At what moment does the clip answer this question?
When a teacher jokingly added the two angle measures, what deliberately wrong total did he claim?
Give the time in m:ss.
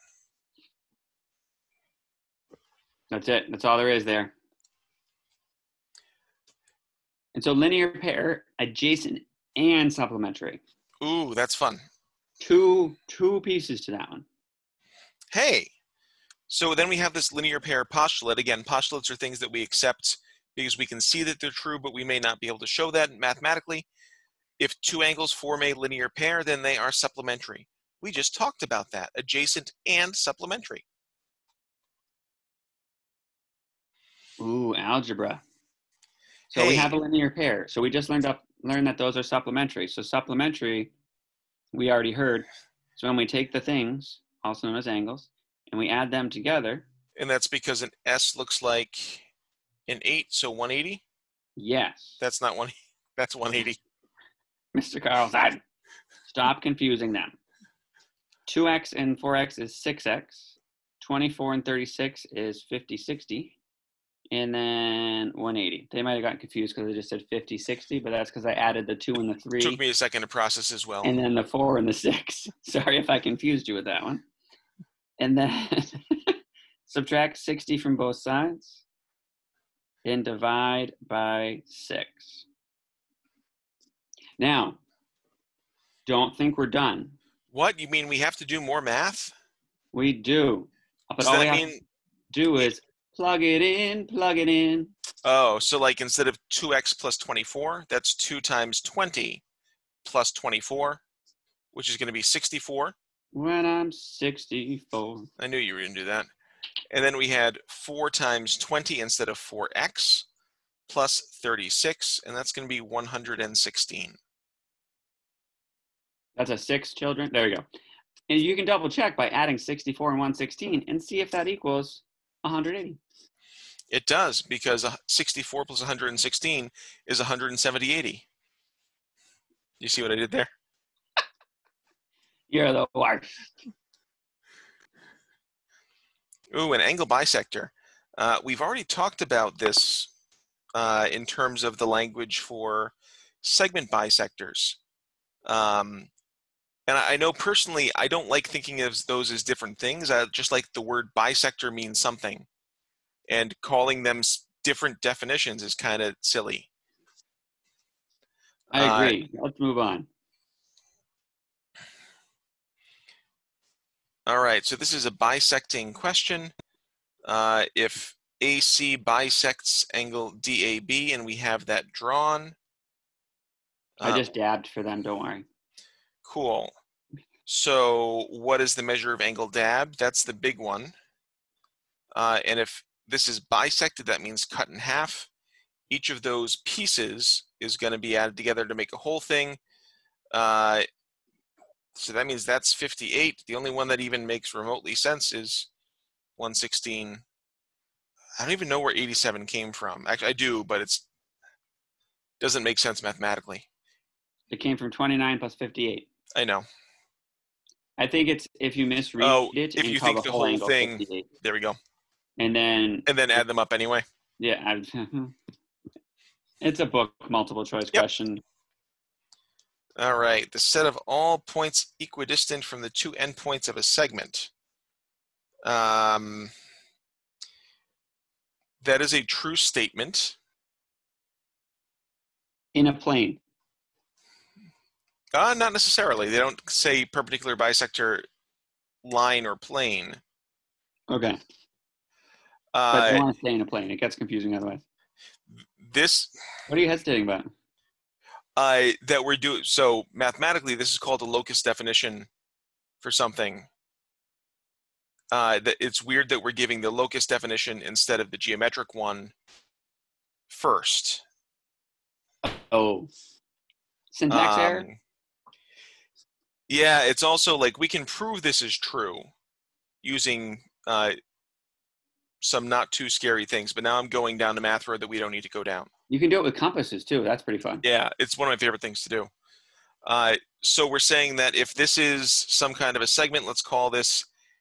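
2:07.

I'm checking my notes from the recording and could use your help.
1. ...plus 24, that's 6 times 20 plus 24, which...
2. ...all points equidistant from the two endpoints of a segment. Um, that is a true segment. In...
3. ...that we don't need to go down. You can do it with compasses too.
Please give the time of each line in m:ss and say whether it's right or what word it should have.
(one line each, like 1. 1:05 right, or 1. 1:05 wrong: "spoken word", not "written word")
1. 1:36 wrong: "2", not "6"
2. 3:41 wrong: "statement", not "segment"
3. 4:35 right.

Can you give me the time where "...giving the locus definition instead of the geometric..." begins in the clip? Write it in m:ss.
4:16.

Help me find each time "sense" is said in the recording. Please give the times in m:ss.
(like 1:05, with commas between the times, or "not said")
3:14, 3:22.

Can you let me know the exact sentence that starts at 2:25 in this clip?
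Um, and I know personally, I don't like thinking of those as different things.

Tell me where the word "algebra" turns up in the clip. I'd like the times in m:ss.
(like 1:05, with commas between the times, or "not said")
0:34.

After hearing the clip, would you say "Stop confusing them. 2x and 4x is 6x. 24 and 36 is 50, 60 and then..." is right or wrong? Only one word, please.
right.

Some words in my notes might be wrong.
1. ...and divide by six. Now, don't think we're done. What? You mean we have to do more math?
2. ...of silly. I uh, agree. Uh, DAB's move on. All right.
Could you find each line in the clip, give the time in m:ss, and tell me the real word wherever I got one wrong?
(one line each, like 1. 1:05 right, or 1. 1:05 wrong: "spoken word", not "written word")
1. 1:20 right
2. 2:36 wrong: "Let", not "DAB".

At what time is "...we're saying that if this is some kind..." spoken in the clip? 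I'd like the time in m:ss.
4:40.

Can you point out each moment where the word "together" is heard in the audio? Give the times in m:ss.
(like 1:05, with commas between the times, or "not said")
0:46, 3:08.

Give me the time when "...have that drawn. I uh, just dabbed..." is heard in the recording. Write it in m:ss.
2:51.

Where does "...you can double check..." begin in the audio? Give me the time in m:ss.
1:58.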